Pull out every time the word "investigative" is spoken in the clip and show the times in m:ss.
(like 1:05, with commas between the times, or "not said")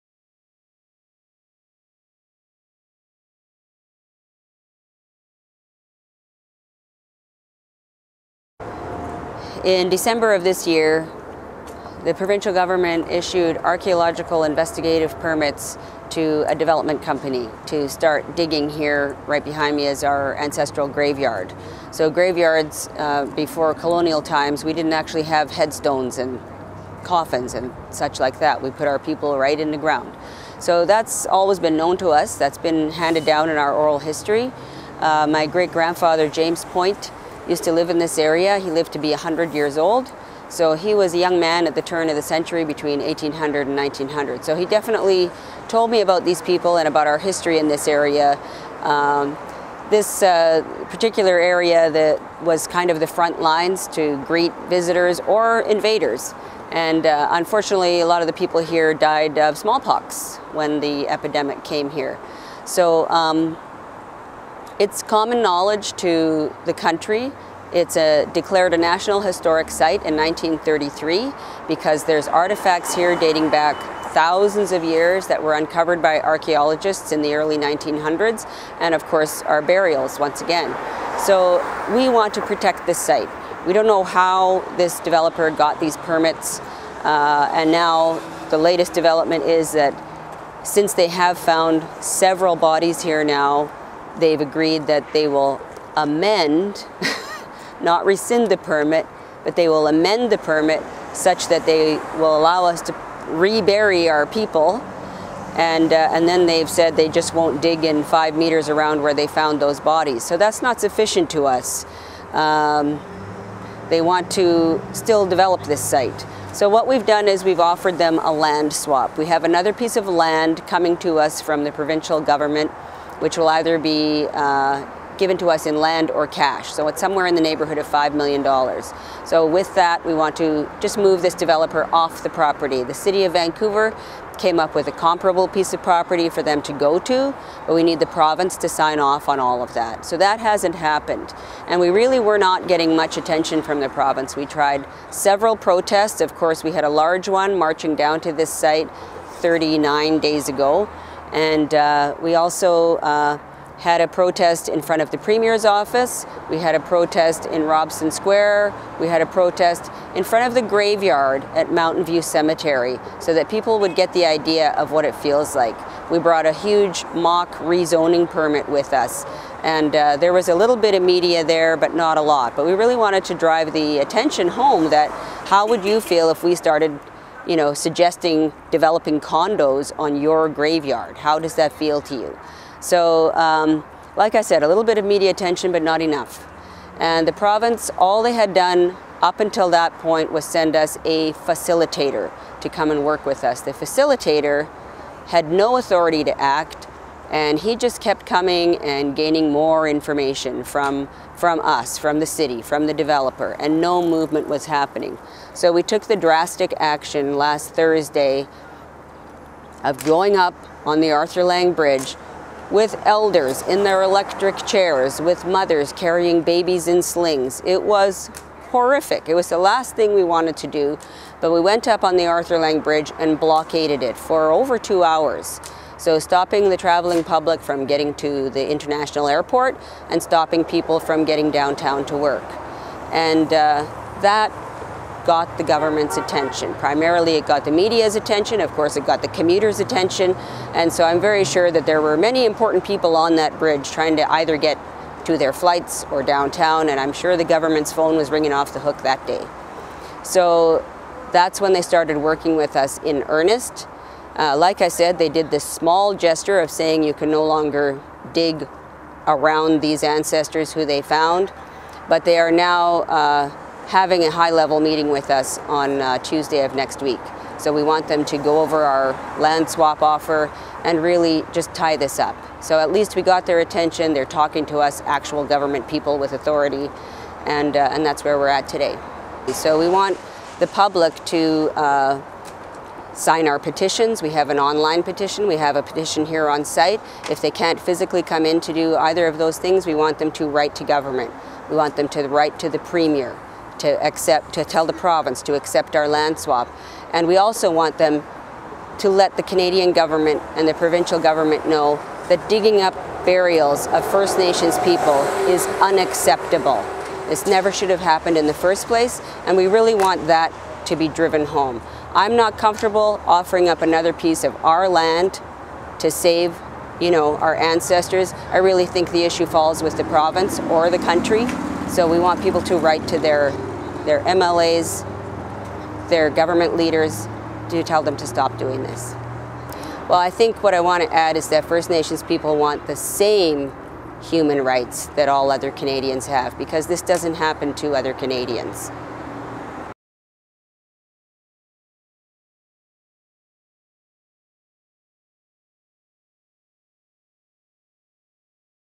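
0:14.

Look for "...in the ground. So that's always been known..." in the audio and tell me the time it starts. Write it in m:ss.
0:29.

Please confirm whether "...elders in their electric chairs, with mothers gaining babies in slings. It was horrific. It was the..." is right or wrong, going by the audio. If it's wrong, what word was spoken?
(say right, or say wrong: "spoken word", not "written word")
wrong: "carrying", not "gaining".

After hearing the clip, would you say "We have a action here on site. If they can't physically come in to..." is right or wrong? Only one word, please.
wrong.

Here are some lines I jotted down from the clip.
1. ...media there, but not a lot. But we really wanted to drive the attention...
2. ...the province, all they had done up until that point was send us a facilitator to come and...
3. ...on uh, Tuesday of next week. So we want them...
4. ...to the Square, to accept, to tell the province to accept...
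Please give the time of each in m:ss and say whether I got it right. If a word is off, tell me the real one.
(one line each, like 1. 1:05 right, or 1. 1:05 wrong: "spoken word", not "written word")
1. 2:51 right
2. 3:07 right
3. 4:25 right
4. 4:52 wrong: "Premier", not "Square".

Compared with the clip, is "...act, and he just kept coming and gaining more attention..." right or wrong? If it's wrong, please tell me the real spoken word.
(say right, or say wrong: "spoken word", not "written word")
wrong: "information", not "attention".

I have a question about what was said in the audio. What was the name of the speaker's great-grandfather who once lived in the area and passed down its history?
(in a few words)
James Point.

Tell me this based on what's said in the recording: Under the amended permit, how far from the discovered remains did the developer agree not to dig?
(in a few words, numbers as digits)
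5 meters.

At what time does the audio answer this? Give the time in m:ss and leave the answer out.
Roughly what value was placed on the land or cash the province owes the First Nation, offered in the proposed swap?
2:07.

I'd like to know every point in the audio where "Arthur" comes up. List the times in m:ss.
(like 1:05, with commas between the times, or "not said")
3:31, 3:42.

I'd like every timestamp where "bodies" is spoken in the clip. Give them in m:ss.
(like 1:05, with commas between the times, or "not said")
1:32, 1:49.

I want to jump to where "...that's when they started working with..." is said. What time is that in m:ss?
4:11.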